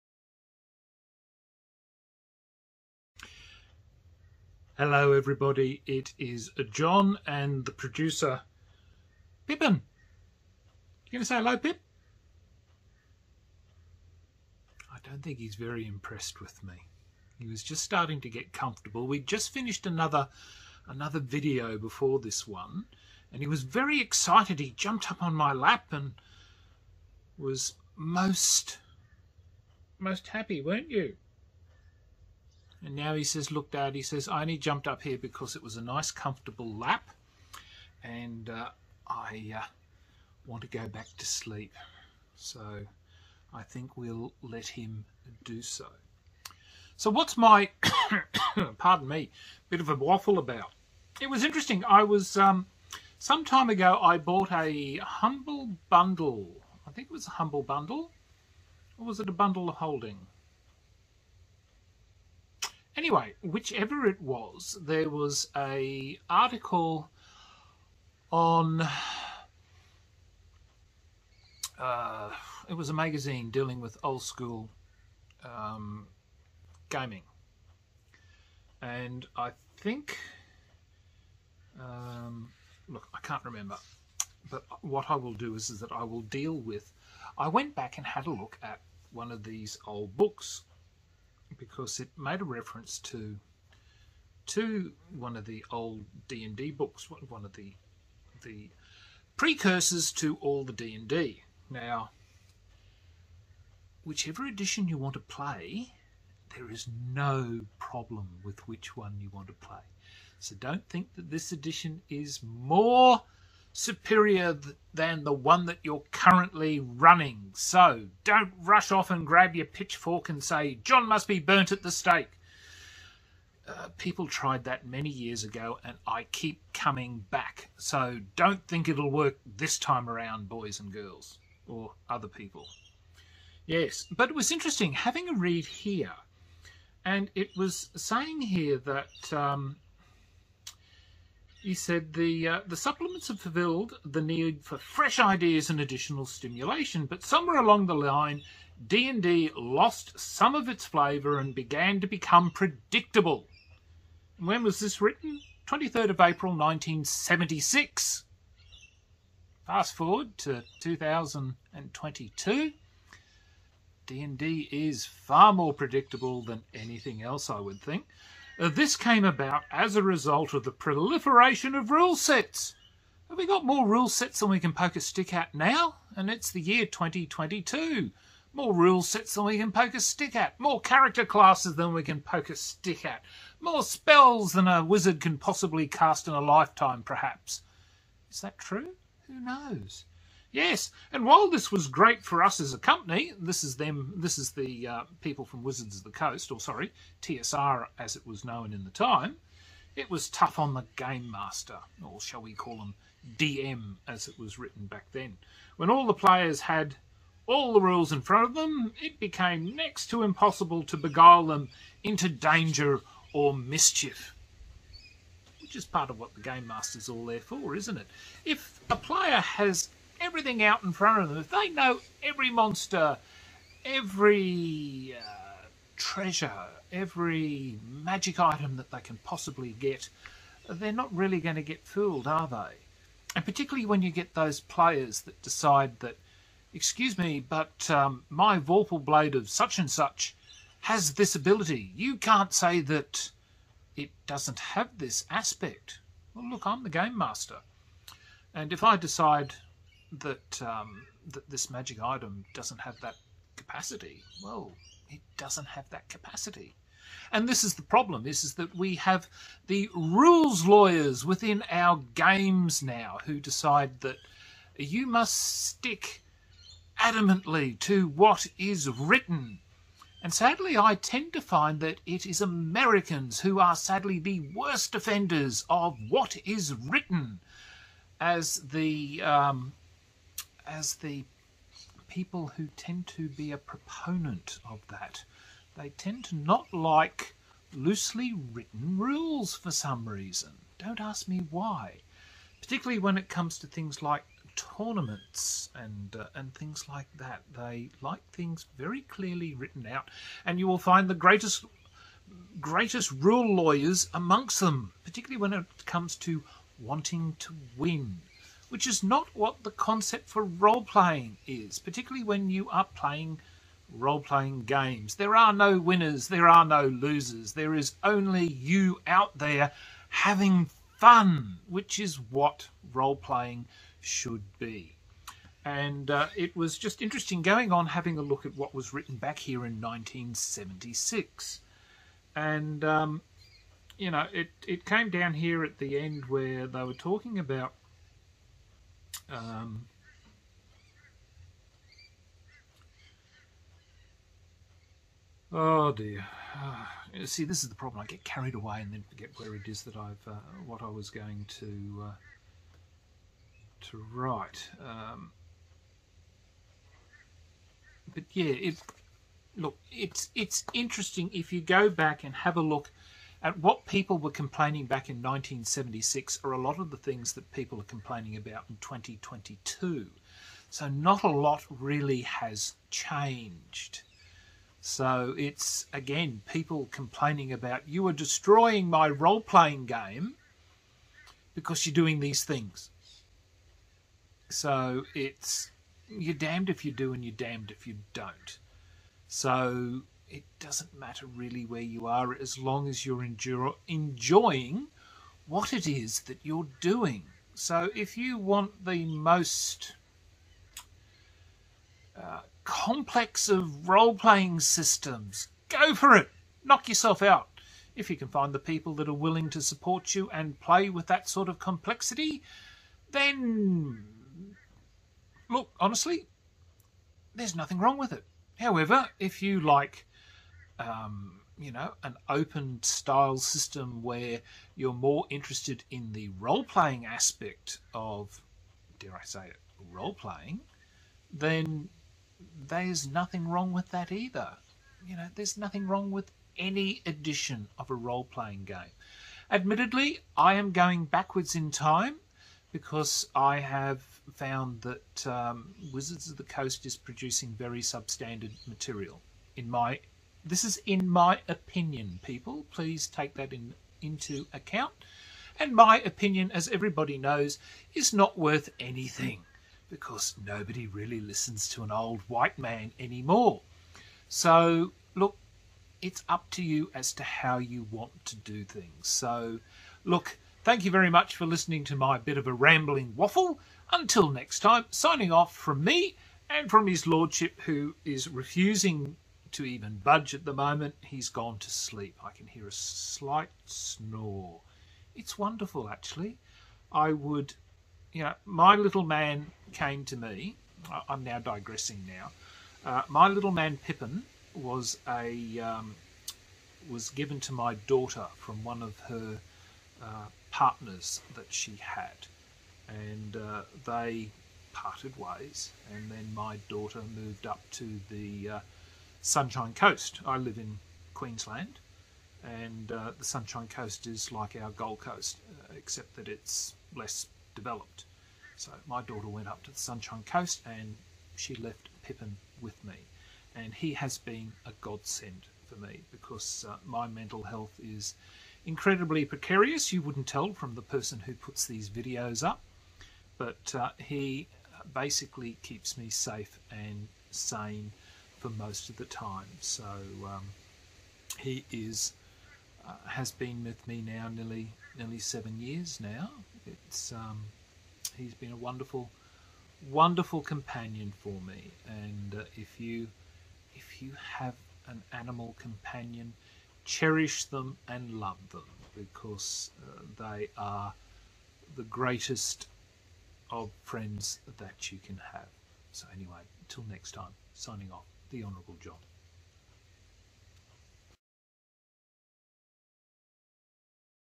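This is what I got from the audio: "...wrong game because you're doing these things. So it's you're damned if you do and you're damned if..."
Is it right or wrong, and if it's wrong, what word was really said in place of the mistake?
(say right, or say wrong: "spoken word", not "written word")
wrong: "playing", not "wrong".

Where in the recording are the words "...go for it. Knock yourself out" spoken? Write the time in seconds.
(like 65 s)
405 s.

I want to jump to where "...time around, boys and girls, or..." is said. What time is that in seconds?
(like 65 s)
129 s.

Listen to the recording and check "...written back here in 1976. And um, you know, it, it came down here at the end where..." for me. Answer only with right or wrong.
right.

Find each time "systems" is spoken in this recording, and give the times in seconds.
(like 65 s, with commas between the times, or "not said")
404 s, 423 s.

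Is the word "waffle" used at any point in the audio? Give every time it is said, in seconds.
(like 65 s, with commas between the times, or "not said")
49 s, 473 s.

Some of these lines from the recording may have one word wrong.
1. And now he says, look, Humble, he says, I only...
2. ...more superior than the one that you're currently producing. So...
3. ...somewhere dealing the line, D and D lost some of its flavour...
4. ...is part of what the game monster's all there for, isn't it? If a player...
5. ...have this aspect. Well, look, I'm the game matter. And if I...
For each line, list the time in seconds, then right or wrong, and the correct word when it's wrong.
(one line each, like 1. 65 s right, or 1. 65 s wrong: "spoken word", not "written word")
1. 32 s wrong: "Dad", not "Humble"
2. 112 s wrong: "running", not "producing"
3. 147 s wrong: "along", not "dealing"
4. 215 s wrong: "master", not "monster"
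5. 244 s wrong: "master", not "matter".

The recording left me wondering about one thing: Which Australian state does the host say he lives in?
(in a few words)
Queensland.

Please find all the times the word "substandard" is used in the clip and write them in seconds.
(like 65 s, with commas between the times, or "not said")
447 s.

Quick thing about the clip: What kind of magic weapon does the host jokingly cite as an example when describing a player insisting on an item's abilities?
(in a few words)
Vorpal Blade.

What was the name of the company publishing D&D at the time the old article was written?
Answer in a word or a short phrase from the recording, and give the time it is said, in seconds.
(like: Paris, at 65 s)
TSR, at 197 s.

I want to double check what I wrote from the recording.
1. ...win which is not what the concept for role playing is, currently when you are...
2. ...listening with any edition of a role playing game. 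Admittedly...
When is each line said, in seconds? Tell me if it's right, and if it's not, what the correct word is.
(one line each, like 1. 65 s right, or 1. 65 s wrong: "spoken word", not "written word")
1. 307 s wrong: "particularly", not "currently"
2. 435 s wrong: "wrong", not "listening".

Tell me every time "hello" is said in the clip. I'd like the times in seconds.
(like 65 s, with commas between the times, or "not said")
4 s, 11 s.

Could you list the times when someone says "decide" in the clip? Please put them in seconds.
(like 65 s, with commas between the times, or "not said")
235 s, 248 s, 263 s.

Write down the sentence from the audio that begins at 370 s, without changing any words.
So not a lot really has changed.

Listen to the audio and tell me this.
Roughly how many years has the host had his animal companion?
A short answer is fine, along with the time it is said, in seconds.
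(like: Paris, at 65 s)
7, at 545 s.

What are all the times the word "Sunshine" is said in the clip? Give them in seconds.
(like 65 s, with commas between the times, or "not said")
509 s, 513 s, 519 s.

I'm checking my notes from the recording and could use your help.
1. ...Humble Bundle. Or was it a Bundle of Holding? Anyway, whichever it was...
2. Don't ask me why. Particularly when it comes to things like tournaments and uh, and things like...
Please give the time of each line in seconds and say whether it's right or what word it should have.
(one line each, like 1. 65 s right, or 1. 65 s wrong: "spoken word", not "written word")
1. 57 s right
2. 290 s right.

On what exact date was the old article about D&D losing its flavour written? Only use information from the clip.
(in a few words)
23rd of April 1976.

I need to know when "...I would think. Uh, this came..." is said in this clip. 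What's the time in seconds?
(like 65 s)
167 s.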